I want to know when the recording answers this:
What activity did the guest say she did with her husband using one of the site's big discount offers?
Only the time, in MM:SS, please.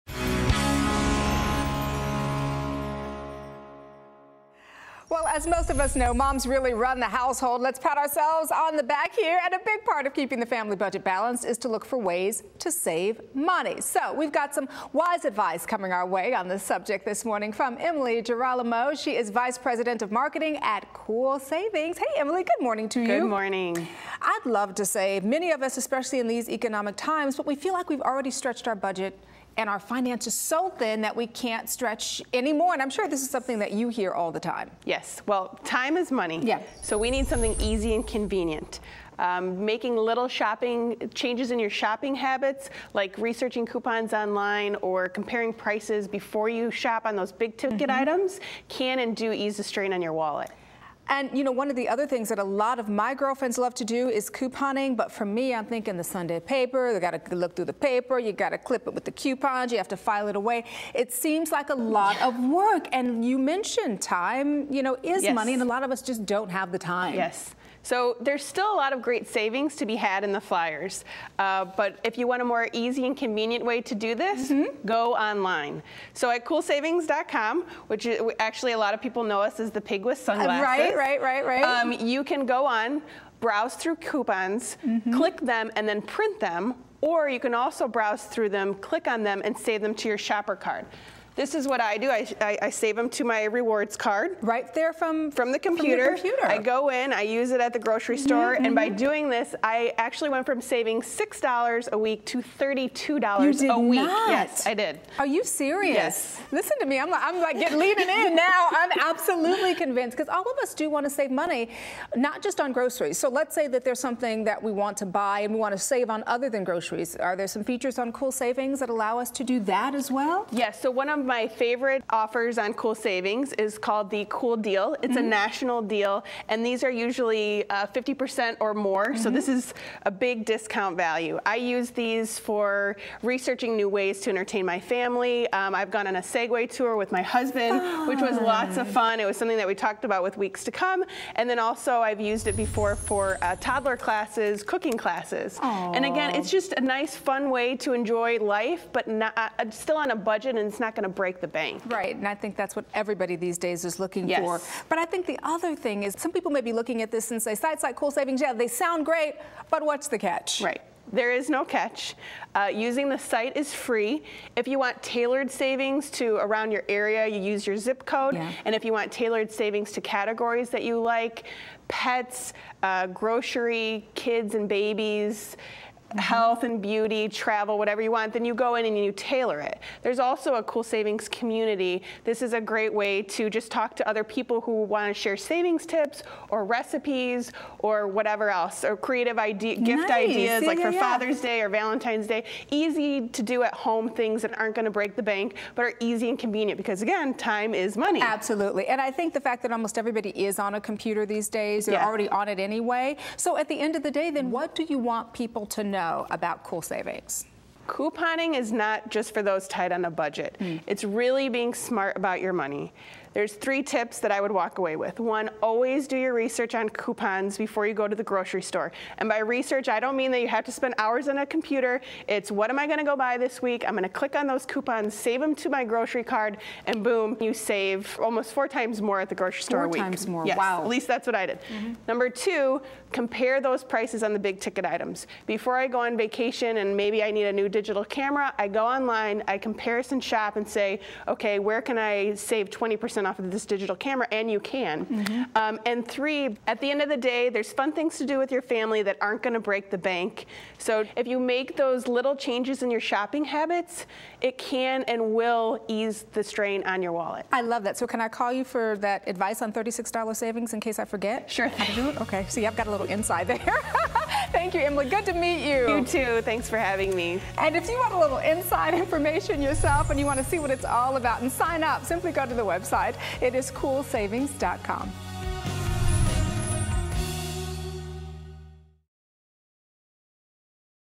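02:16.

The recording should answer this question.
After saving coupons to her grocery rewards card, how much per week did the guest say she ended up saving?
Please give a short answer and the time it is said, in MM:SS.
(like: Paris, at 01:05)
$32, at 01:42.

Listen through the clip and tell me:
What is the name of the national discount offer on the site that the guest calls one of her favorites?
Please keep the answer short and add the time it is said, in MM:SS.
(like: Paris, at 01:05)
Cool Deal, at 02:04.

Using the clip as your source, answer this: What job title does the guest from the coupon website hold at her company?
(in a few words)
Vice President of Marketing.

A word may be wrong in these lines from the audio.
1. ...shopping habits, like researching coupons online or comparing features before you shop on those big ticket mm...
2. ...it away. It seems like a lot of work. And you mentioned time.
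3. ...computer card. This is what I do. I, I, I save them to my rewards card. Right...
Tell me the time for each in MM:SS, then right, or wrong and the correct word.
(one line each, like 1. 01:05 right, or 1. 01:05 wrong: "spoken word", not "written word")
1. 00:41 wrong: "prices", not "features"
2. 01:00 right
3. 01:30 wrong: "shopper", not "computer".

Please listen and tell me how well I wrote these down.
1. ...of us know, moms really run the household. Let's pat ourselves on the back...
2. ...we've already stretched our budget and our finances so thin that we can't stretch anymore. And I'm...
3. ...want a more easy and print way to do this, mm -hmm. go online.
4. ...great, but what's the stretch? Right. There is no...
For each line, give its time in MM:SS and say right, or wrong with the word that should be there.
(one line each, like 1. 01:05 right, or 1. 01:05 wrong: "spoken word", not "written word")
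1. 00:05 right
2. 00:27 right
3. 01:12 wrong: "convenient", not "print"
4. 02:39 wrong: "catch", not "stretch".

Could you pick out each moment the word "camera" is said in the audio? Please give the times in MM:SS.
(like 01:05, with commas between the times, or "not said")
03:58, 04:03.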